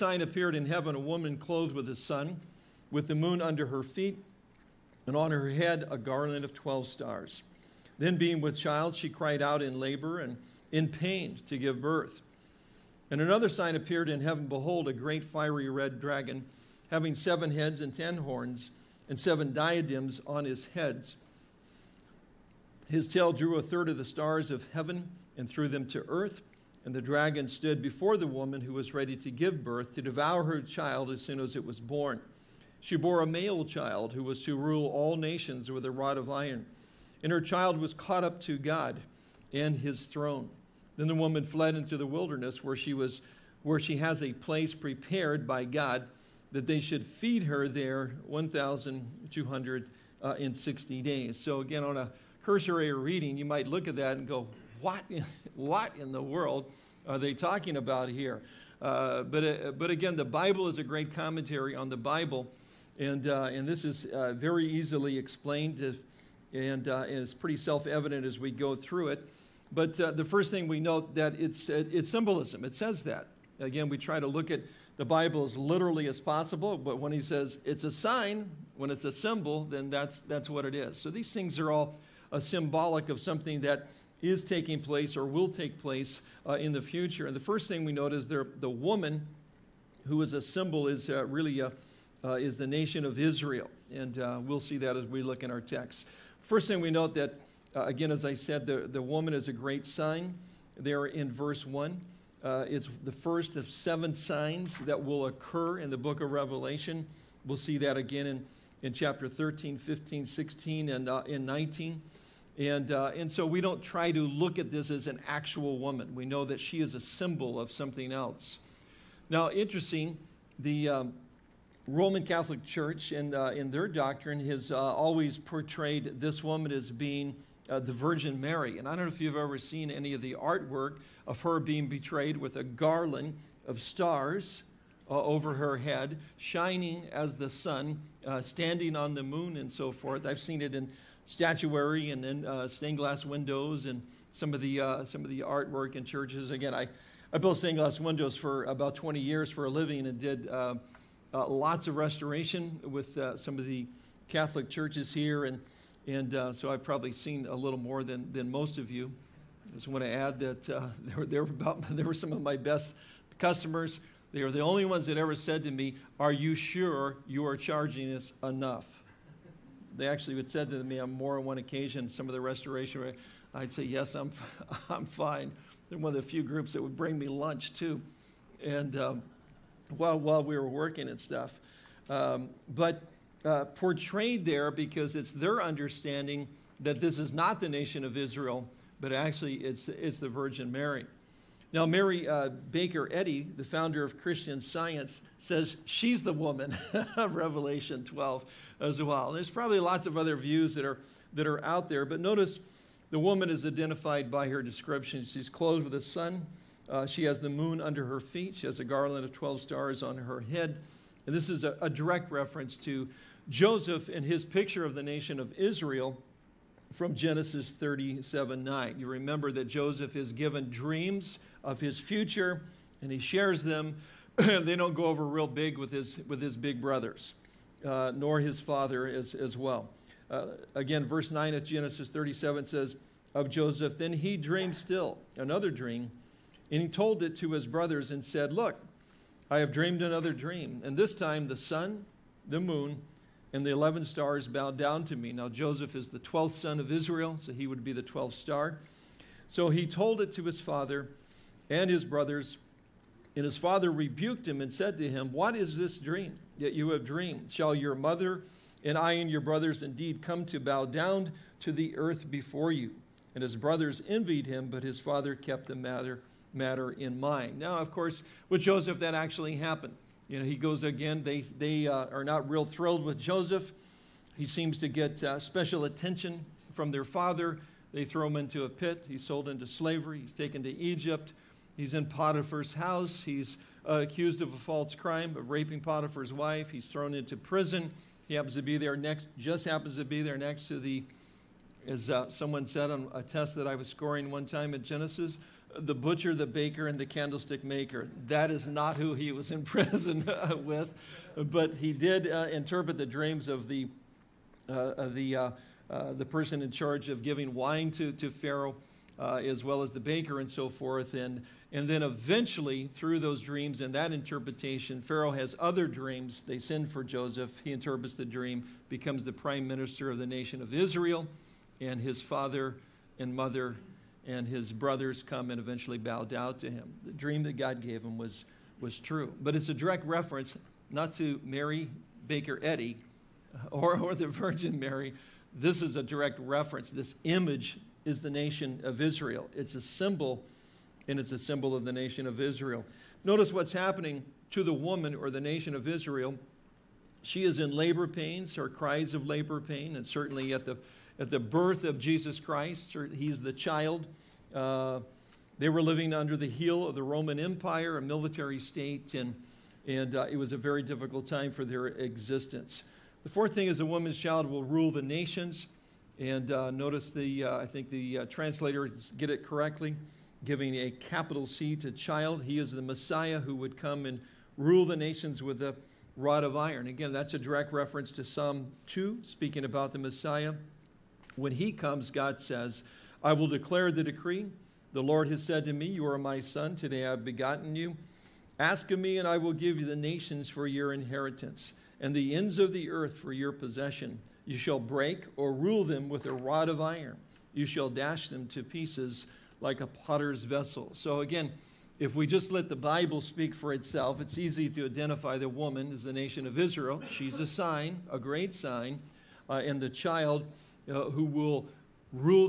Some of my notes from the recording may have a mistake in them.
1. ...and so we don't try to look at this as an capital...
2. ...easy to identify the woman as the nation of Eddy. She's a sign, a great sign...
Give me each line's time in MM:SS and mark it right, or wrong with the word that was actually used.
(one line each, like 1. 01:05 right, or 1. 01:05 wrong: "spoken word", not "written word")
1. 01:53 wrong: "actual", not "capital"
2. 06:44 wrong: "Israel", not "Eddy".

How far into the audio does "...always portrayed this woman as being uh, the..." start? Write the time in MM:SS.
02:04.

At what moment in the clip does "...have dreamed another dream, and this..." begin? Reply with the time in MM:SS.
03:59.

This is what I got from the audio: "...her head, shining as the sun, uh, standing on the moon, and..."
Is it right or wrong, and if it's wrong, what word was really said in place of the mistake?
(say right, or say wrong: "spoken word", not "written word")
right.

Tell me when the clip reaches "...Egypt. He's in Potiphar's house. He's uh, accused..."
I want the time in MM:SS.
04:40.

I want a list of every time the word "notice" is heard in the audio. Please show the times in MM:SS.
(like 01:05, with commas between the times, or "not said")
03:22, 05:43, 06:06.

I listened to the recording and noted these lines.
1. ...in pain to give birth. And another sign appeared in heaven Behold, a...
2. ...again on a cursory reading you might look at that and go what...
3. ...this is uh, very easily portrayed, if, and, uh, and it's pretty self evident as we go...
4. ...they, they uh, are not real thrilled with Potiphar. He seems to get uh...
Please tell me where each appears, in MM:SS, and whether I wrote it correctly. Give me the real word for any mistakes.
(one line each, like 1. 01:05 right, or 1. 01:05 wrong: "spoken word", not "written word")
1. 00:10 right
2. 00:51 right
3. 01:03 wrong: "explained", not "portrayed"
4. 04:31 wrong: "Joseph", not "Potiphar".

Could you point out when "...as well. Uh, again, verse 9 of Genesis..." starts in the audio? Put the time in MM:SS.
03:49.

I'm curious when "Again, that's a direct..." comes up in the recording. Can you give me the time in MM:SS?
06:16.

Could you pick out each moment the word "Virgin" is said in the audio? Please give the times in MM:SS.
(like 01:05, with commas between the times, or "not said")
02:07, 03:10, 05:34.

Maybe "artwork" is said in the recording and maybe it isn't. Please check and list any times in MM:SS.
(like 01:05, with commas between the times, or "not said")
02:10, 02:25.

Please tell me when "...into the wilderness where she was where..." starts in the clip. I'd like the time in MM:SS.
00:41.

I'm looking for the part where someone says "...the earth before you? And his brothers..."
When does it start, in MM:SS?
04:21.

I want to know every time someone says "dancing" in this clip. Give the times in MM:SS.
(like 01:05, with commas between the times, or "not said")
not said.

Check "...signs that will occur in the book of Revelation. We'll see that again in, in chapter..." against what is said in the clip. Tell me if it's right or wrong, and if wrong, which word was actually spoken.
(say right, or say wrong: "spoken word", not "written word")
right.